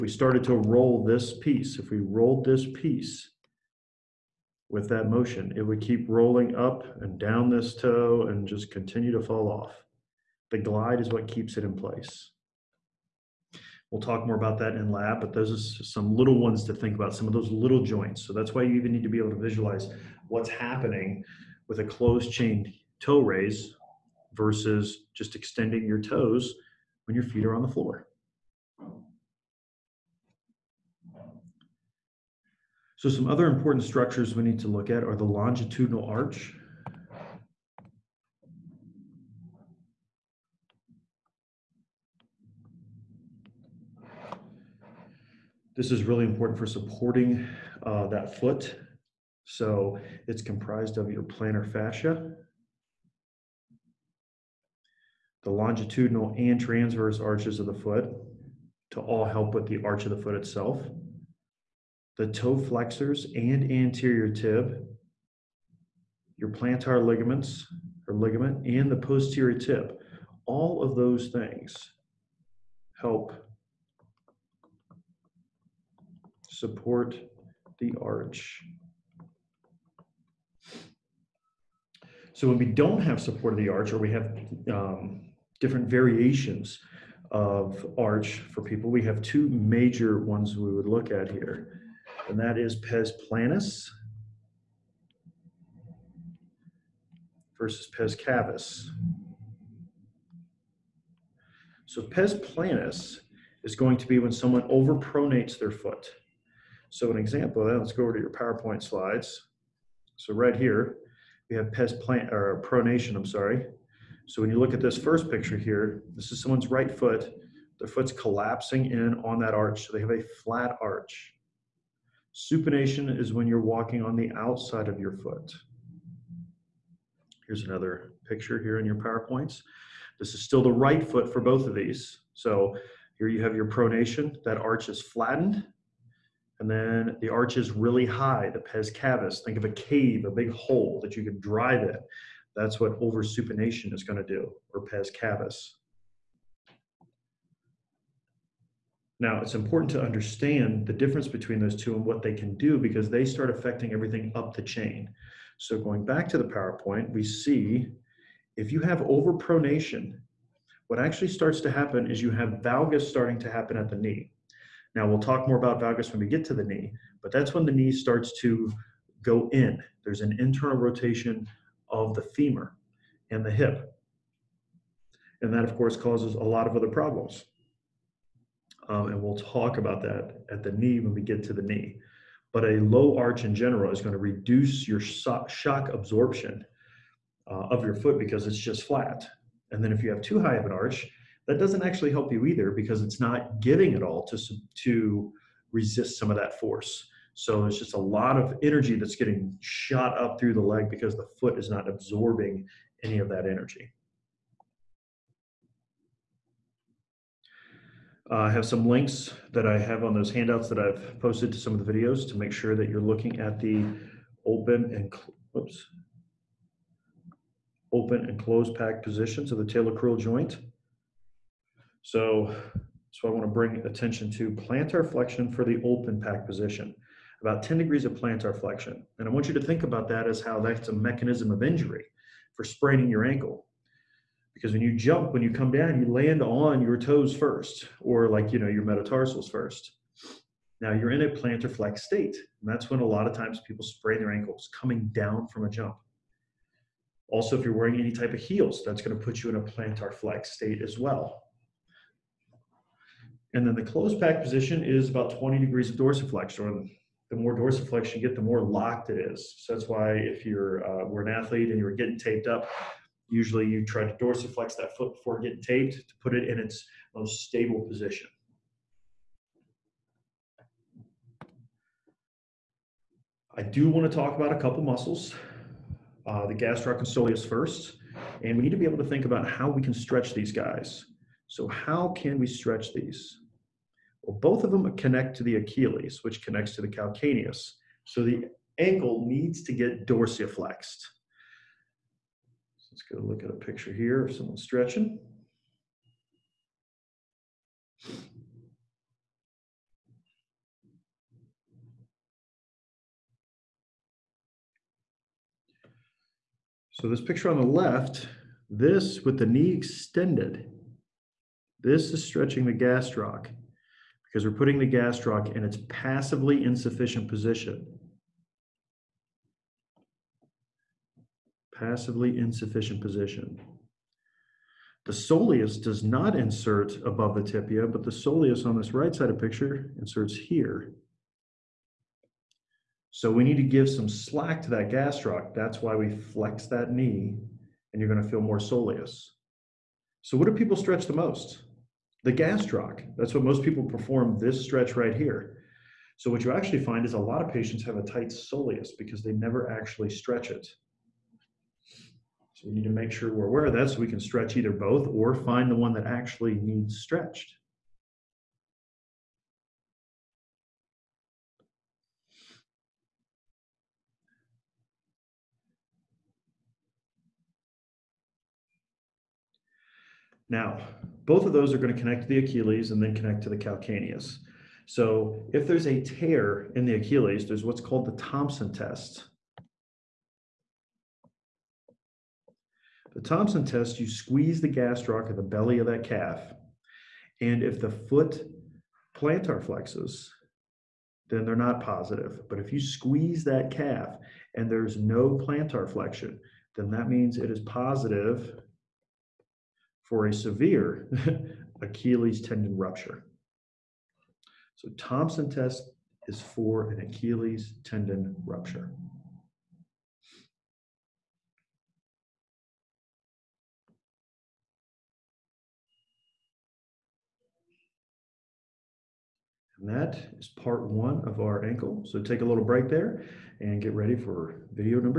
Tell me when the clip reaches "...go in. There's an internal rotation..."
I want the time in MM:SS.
02:49.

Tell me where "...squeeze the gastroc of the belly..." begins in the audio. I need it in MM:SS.
06:24.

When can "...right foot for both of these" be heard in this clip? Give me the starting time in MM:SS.
02:10.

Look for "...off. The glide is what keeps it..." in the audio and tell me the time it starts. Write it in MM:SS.
00:09.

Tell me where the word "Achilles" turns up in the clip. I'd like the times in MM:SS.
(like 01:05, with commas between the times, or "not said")
04:45, 06:12, 06:16, 06:41, 06:47.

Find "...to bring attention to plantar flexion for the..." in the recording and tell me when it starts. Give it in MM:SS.
03:43.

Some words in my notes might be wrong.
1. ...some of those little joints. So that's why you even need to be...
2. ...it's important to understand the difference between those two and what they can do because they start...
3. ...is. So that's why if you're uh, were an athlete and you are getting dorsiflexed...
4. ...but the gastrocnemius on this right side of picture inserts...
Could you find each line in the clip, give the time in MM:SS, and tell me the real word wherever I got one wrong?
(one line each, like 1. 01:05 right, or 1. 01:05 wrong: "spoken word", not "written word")
1. 00:17 right
2. 02:29 right
3. 04:19 wrong: "taped", not "dorsiflexed"
4. 05:27 wrong: "soleus", not "gastrocnemius".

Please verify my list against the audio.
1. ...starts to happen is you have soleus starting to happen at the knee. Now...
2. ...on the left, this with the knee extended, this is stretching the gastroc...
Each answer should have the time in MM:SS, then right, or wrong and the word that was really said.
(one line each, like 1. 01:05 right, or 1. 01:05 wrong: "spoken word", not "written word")
1. 02:41 wrong: "valgus", not "soleus"
2. 05:07 right.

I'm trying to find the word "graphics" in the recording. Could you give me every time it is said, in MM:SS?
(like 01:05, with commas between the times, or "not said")
not said.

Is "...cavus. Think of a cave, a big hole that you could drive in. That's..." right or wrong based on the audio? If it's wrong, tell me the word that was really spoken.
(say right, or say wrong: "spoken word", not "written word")
right.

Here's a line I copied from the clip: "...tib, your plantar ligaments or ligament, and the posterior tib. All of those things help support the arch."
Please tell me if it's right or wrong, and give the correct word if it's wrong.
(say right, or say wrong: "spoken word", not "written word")
right.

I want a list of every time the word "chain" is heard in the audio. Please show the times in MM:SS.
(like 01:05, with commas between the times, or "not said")
00:22, 02:34.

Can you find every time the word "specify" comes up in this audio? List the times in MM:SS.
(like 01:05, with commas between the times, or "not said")
not said.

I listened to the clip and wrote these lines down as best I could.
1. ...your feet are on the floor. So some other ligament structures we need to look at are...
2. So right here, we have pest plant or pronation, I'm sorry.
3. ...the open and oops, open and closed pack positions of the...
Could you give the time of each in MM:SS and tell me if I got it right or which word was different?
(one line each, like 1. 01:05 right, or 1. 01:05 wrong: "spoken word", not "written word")
1. 00:27 wrong: "important", not "ligament"
2. 01:50 right
3. 03:33 right.